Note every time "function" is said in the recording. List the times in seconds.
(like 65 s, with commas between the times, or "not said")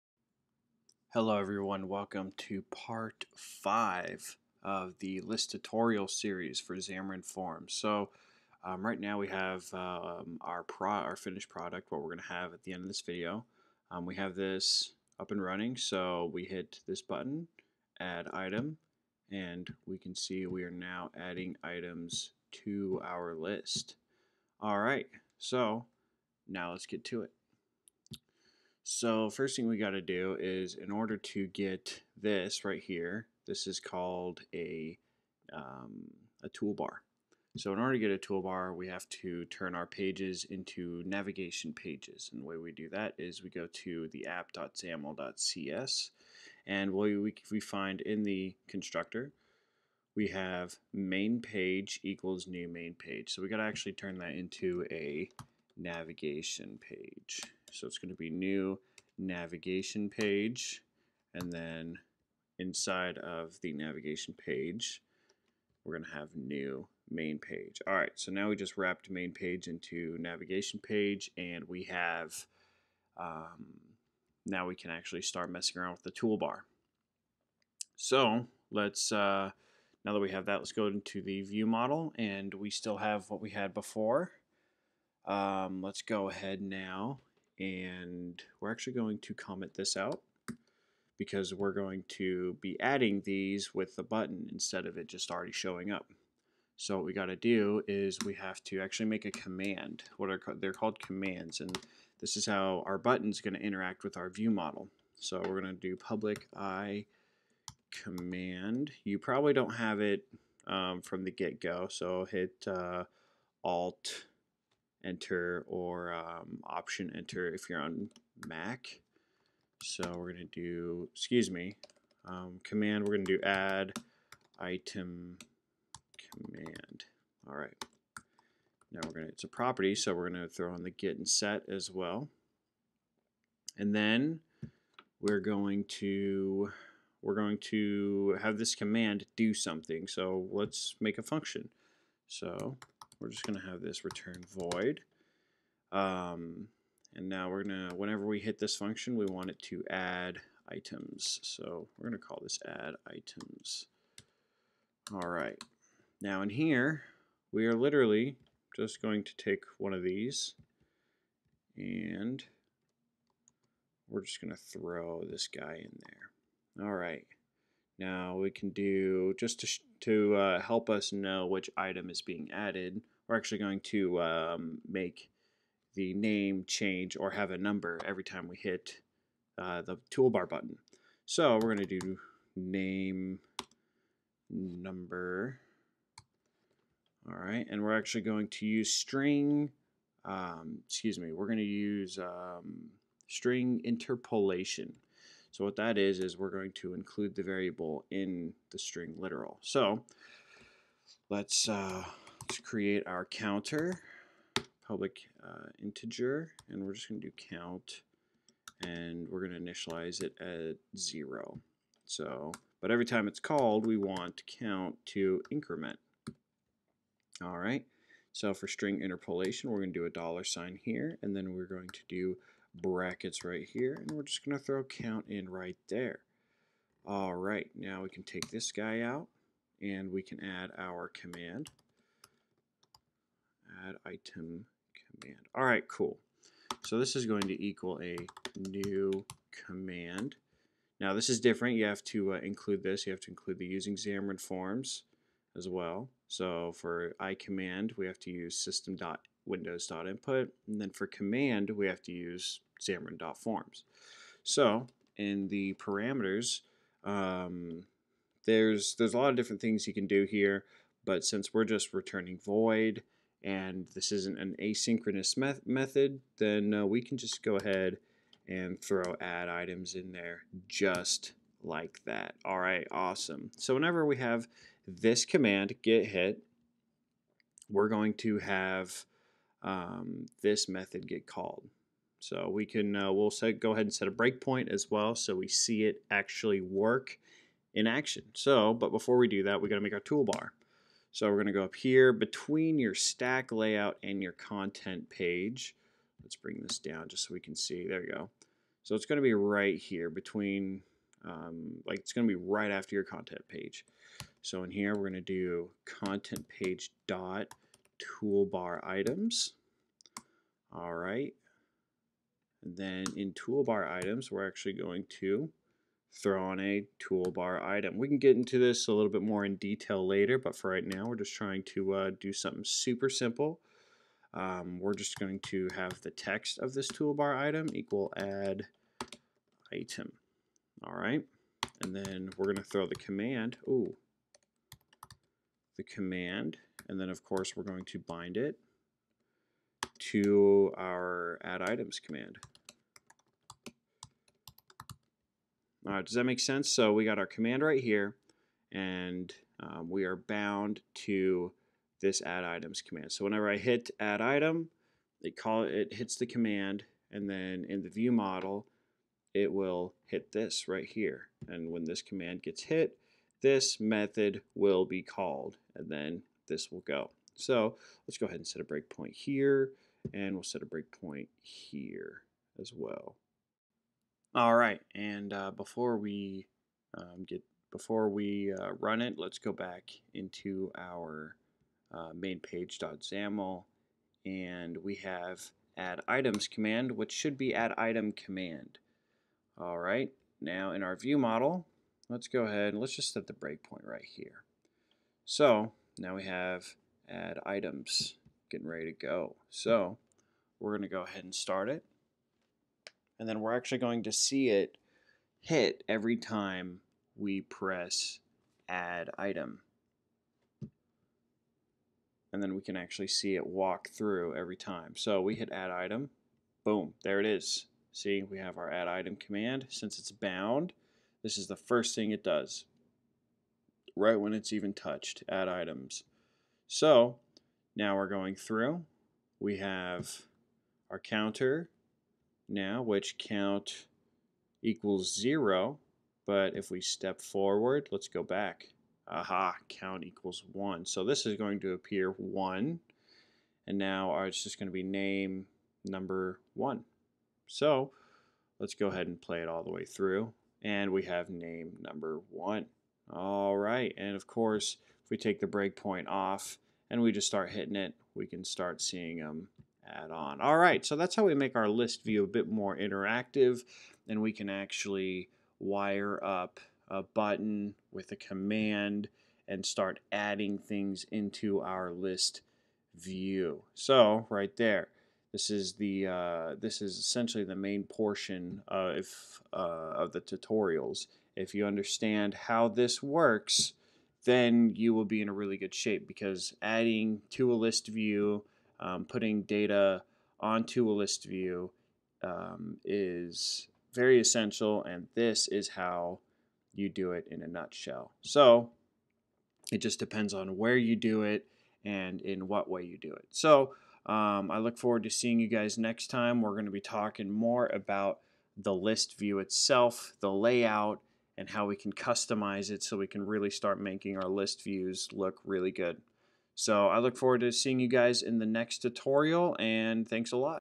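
141 s, 148 s.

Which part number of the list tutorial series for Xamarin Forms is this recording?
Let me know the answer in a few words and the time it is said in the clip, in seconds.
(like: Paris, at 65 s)
5, at 2 s.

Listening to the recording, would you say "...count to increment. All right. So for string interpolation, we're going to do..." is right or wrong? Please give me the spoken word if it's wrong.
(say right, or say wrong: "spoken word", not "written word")
right.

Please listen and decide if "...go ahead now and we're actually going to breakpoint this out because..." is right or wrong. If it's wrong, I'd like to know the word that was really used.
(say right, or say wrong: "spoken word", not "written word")
wrong: "comment", not "breakpoint".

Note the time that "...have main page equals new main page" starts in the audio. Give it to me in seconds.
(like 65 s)
50 s.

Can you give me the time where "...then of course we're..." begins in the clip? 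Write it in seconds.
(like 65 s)
336 s.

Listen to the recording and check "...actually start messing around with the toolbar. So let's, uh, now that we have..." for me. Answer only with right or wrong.
right.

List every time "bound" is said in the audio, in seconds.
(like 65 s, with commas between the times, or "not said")
350 s, 420 s.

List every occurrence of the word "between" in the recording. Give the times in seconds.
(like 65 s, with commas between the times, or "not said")
292 s, 300 s.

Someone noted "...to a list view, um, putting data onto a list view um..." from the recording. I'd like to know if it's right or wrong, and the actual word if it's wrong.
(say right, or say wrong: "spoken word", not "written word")
right.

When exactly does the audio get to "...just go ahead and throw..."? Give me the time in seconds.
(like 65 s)
267 s.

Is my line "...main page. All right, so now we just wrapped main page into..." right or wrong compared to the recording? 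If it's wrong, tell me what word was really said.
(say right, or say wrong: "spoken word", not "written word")
right.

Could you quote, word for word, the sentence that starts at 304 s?
So in here, we're gonna do content page dot toolbar items.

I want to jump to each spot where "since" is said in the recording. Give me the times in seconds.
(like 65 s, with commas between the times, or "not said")
261 s, 419 s.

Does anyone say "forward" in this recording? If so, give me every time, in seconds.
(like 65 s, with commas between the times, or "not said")
437 s, 504 s, 517 s.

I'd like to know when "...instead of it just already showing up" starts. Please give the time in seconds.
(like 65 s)
94 s.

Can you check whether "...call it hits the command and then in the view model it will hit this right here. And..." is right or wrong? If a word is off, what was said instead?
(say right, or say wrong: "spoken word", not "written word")
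right.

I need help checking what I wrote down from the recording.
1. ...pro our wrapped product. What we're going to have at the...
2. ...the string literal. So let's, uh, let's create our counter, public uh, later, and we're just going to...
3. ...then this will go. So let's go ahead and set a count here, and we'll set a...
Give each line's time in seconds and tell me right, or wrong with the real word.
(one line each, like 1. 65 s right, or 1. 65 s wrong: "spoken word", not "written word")
1. 10 s wrong: "finished", not "wrapped"
2. 198 s wrong: "integer", not "later"
3. 365 s wrong: "breakpoint", not "count".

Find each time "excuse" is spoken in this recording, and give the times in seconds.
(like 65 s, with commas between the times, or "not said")
121 s, 190 s.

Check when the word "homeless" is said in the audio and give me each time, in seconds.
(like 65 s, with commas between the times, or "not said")
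not said.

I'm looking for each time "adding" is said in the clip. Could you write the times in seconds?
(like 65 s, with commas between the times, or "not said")
21 s, 92 s, 470 s, 486 s.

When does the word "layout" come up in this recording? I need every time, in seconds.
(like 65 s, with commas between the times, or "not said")
293 s, 510 s.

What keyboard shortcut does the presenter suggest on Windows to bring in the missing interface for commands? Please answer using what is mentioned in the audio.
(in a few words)
Alt enter.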